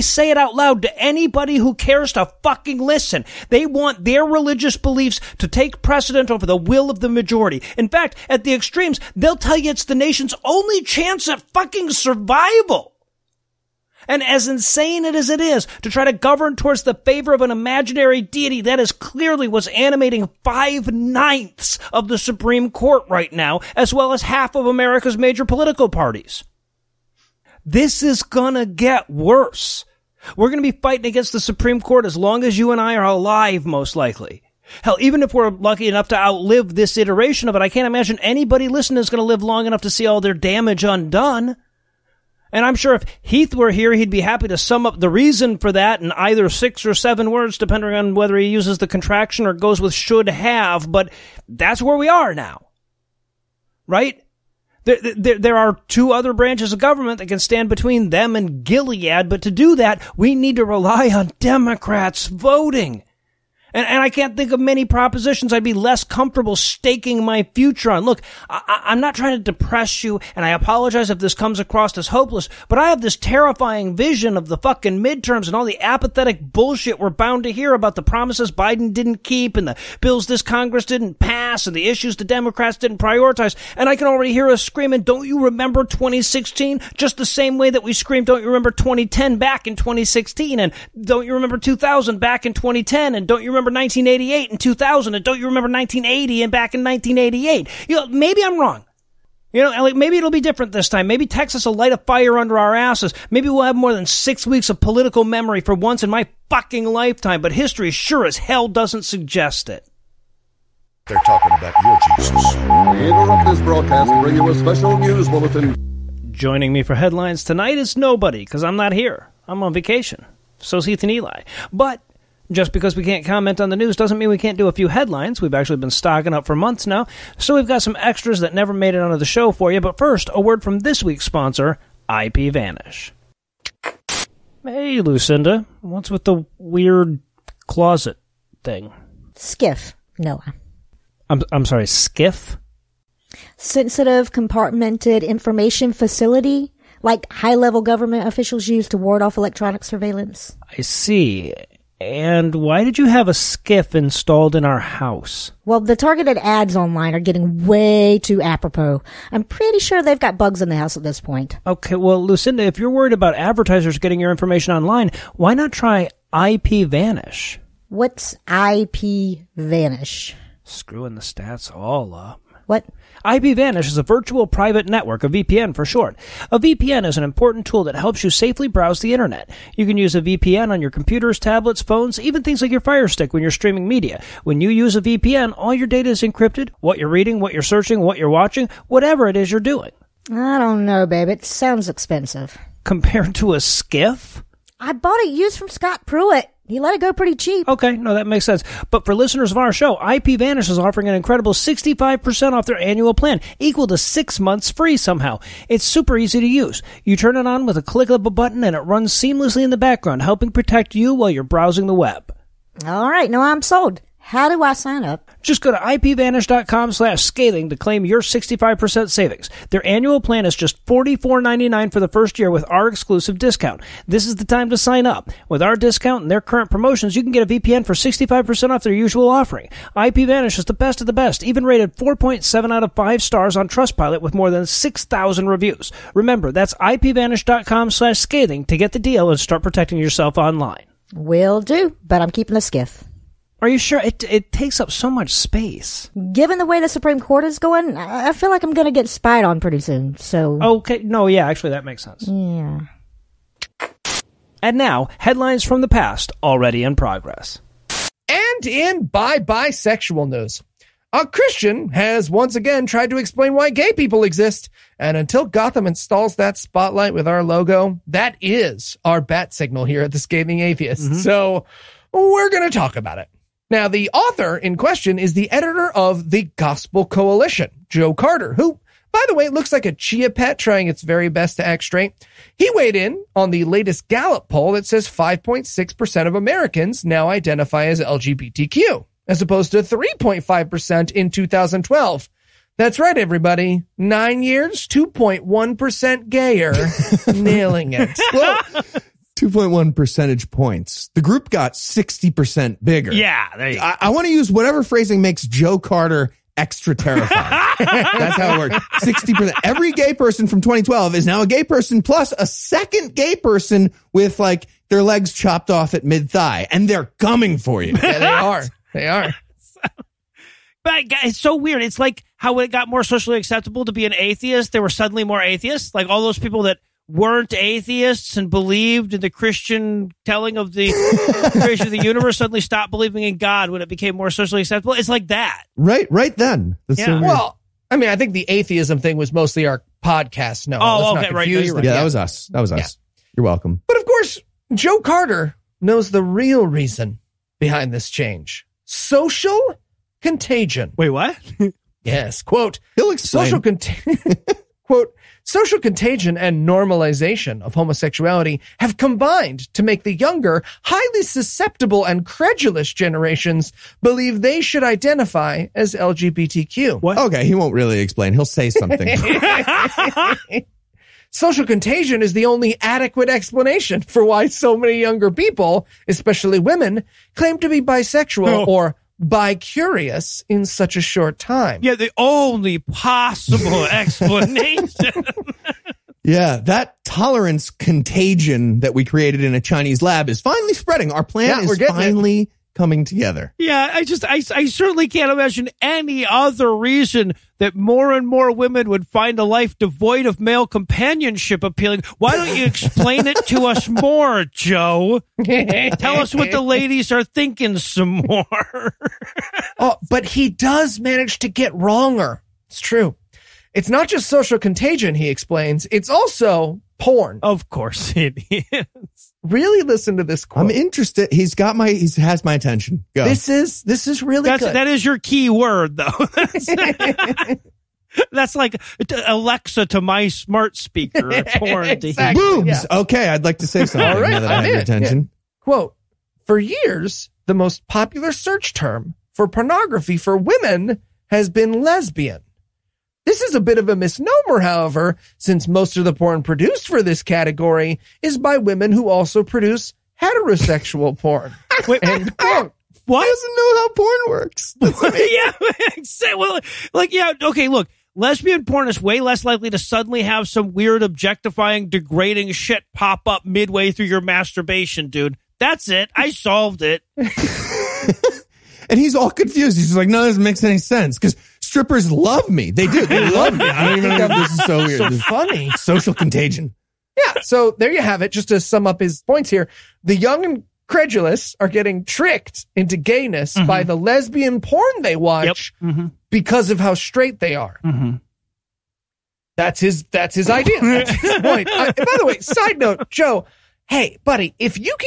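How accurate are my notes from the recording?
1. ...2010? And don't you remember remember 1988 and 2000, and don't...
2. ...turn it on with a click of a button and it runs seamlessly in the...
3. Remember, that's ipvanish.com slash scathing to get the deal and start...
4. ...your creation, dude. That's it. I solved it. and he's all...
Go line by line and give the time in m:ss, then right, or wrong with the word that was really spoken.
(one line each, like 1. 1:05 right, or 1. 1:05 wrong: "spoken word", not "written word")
1. 1:32 right
2. 3:27 right
3. 3:56 right
4. 7:44 wrong: "masturbation", not "creation".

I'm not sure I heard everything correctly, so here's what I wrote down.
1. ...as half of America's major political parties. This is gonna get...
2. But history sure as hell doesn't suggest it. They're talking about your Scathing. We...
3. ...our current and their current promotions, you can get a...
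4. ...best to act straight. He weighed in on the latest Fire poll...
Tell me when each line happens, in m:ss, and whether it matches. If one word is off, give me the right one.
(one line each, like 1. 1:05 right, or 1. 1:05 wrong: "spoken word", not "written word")
1. 0:24 right
2. 1:47 wrong: "Jesus", not "Scathing"
3. 3:45 wrong: "discount", not "current"
4. 4:41 wrong: "Gallup", not "Fire".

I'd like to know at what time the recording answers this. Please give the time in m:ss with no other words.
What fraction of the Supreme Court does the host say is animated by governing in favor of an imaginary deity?
0:20.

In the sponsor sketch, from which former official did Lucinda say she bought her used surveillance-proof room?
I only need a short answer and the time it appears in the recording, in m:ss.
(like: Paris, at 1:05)
Scott Pruitt, at 3:15.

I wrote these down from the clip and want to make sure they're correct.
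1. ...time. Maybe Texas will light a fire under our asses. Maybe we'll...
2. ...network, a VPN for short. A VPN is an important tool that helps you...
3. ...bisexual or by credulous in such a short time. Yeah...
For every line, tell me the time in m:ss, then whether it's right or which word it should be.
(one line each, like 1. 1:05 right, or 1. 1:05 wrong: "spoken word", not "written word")
1. 1:40 right
2. 2:54 right
3. 6:17 wrong: "curious", not "credulous".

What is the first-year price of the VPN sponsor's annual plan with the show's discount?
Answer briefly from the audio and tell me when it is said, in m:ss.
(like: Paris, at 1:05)
$44.99, at 3:40.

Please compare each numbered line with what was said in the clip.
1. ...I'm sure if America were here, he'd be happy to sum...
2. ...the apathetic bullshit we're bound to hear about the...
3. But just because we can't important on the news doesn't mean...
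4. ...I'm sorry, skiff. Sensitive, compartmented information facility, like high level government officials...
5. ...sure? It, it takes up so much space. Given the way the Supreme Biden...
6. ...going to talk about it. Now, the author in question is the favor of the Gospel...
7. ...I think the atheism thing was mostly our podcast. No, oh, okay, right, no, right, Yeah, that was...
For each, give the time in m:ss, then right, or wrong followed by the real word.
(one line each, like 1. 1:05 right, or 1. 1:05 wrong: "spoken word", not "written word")
1. 0:42 wrong: "Heath", not "America"
2. 1:15 right
3. 2:01 wrong: "comment", not "important"
4. 2:21 right
5. 4:03 wrong: "Court", not "Biden"
6. 4:32 wrong: "editor", not "favor"
7. 5:38 right.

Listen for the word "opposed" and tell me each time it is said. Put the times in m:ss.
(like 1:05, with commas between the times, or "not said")
4:49.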